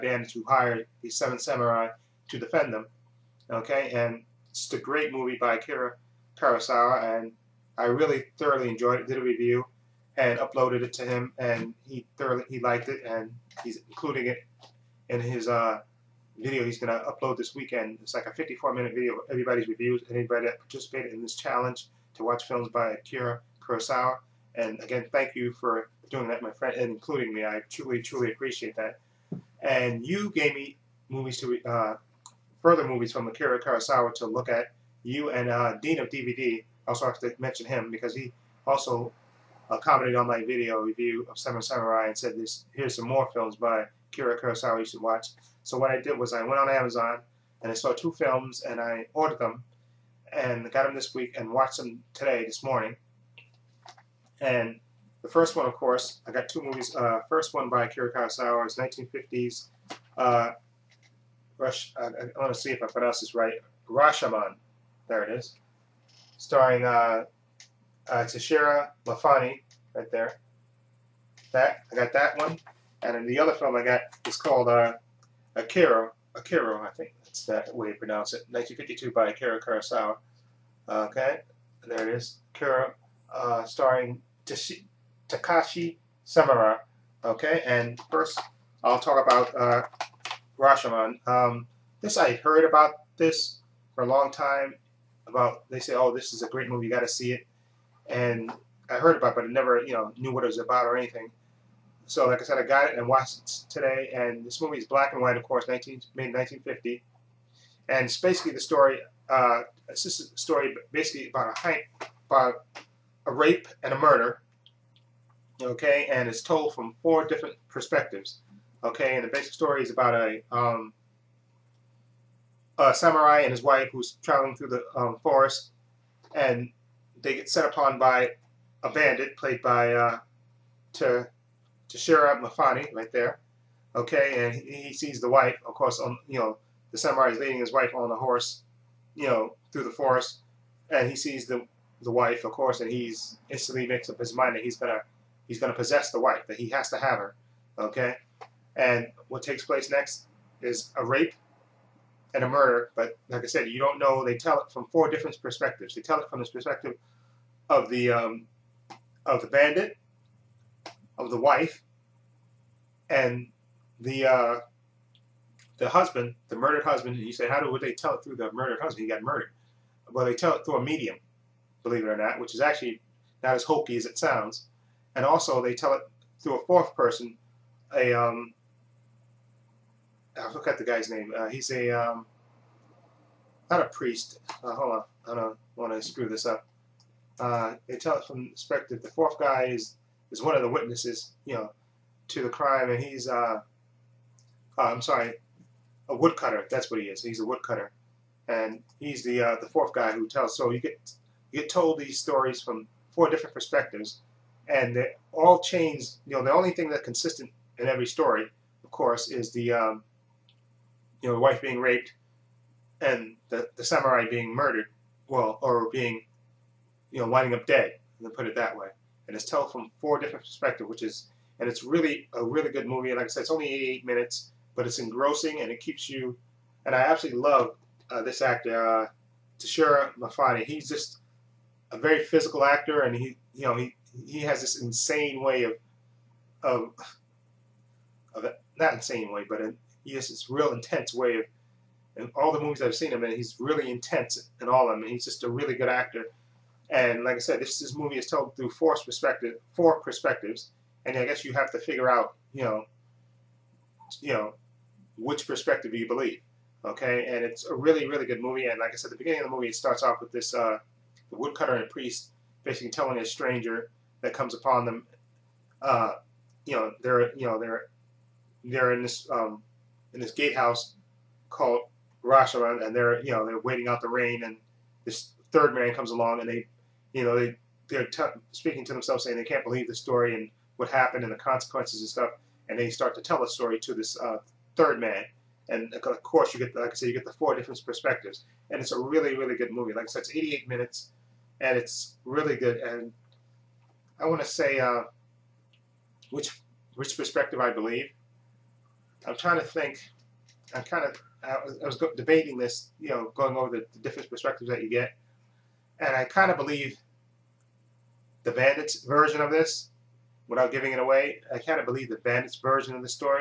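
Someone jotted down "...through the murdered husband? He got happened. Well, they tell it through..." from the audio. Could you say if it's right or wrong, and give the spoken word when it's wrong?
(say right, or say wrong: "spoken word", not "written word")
wrong: "murdered", not "happened".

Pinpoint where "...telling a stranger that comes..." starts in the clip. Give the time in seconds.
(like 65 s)
262 s.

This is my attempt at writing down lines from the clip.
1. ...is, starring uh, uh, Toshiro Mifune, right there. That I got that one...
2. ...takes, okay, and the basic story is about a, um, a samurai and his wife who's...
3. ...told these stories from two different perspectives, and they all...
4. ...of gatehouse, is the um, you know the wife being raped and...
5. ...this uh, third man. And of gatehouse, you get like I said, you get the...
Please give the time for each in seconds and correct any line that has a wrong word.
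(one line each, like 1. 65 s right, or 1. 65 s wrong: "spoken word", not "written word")
1. 65 s right
2. 117 s wrong: "perspectives", not "takes"
3. 201 s wrong: "four", not "two"
4. 208 s wrong: "course", not "gatehouse"
5. 283 s wrong: "course", not "gatehouse".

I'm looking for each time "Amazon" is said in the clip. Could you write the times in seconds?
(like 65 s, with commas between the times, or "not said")
46 s.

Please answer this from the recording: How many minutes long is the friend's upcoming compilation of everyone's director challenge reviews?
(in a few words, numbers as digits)
54.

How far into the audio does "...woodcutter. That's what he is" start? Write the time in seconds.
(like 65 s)
196 s.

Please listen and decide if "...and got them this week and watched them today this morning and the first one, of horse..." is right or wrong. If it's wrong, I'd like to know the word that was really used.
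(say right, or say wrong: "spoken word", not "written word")
wrong: "course", not "horse".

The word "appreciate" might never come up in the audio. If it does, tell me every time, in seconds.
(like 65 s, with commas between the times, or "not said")
28 s.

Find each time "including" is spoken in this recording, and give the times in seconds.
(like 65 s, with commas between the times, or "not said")
13 s, 26 s.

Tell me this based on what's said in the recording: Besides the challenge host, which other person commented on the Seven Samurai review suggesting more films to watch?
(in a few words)
Dean of DVD.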